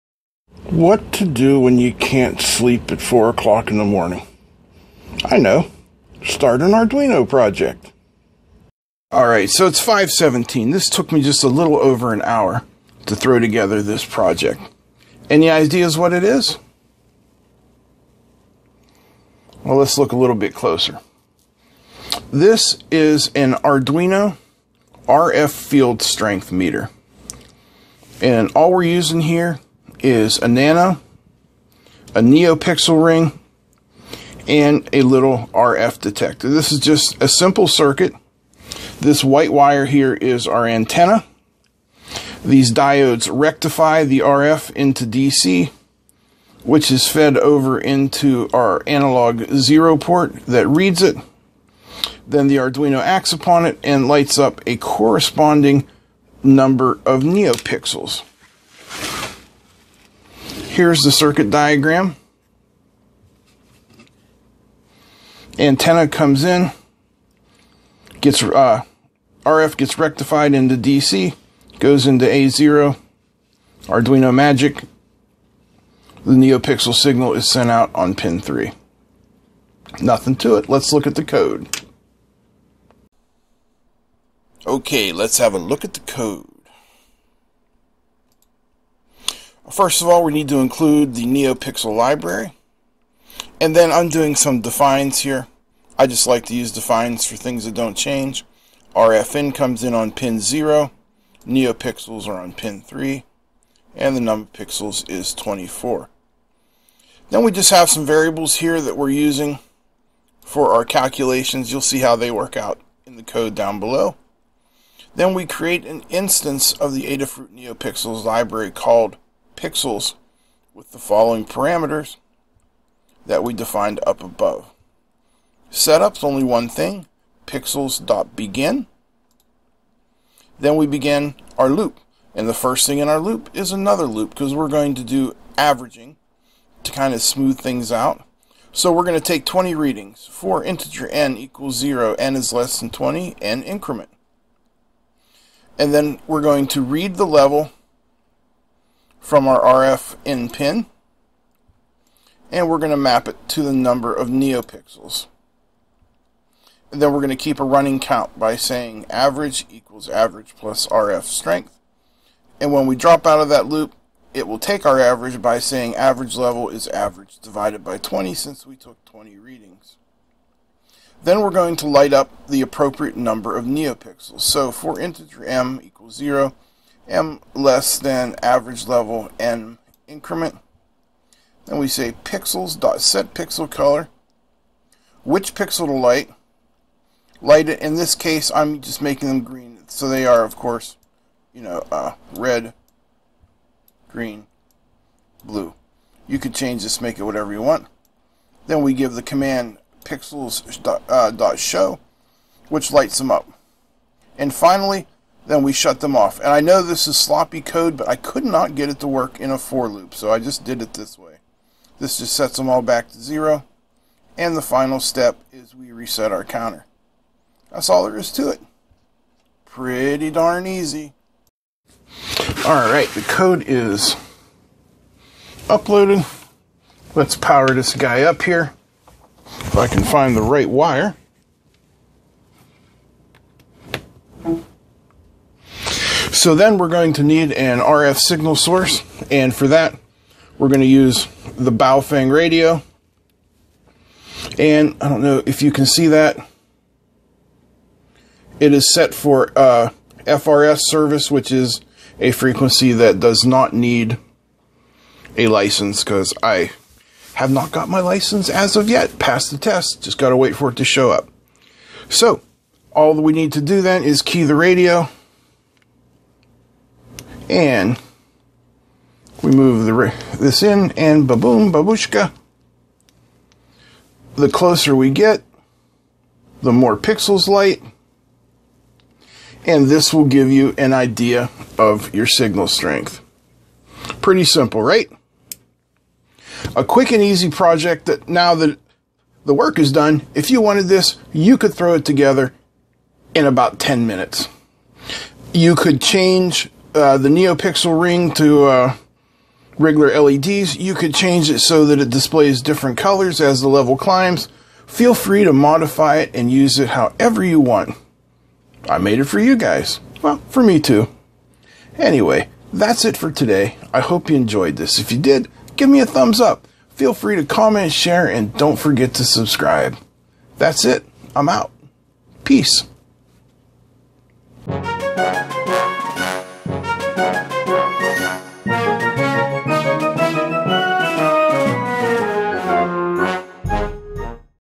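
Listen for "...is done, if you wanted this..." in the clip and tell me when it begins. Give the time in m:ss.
4:49.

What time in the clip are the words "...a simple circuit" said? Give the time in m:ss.
0:37.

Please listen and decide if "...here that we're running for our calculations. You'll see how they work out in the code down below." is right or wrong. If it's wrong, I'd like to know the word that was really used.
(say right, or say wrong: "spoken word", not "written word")
wrong: "using", not "running".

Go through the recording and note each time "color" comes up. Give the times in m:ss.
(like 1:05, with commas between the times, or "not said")
3:03, 5:02.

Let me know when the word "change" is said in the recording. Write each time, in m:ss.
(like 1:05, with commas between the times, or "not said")
1:37, 3:16, 4:56, 5:01.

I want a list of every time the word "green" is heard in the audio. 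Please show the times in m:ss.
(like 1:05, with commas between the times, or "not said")
3:09, 3:14.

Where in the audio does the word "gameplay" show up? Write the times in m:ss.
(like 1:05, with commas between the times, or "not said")
not said.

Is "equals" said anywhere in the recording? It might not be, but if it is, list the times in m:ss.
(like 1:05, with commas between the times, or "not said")
2:21, 2:39, 2:55.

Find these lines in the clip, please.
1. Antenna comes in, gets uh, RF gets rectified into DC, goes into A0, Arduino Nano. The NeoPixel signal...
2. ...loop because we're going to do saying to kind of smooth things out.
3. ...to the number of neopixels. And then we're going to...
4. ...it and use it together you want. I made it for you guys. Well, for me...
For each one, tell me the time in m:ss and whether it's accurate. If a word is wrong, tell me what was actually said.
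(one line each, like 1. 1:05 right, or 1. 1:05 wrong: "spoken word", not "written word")
1. 1:05 wrong: "Magic", not "Nano"
2. 2:14 wrong: "averaging", not "saying"
3. 2:33 right
4. 5:06 wrong: "however", not "together".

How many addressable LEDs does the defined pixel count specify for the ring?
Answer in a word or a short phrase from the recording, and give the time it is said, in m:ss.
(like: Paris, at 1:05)
24, at 1:45.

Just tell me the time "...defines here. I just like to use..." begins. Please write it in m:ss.
1:34.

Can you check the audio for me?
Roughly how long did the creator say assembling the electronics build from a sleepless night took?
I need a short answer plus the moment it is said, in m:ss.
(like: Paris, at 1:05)
a little over an hour, at 0:11.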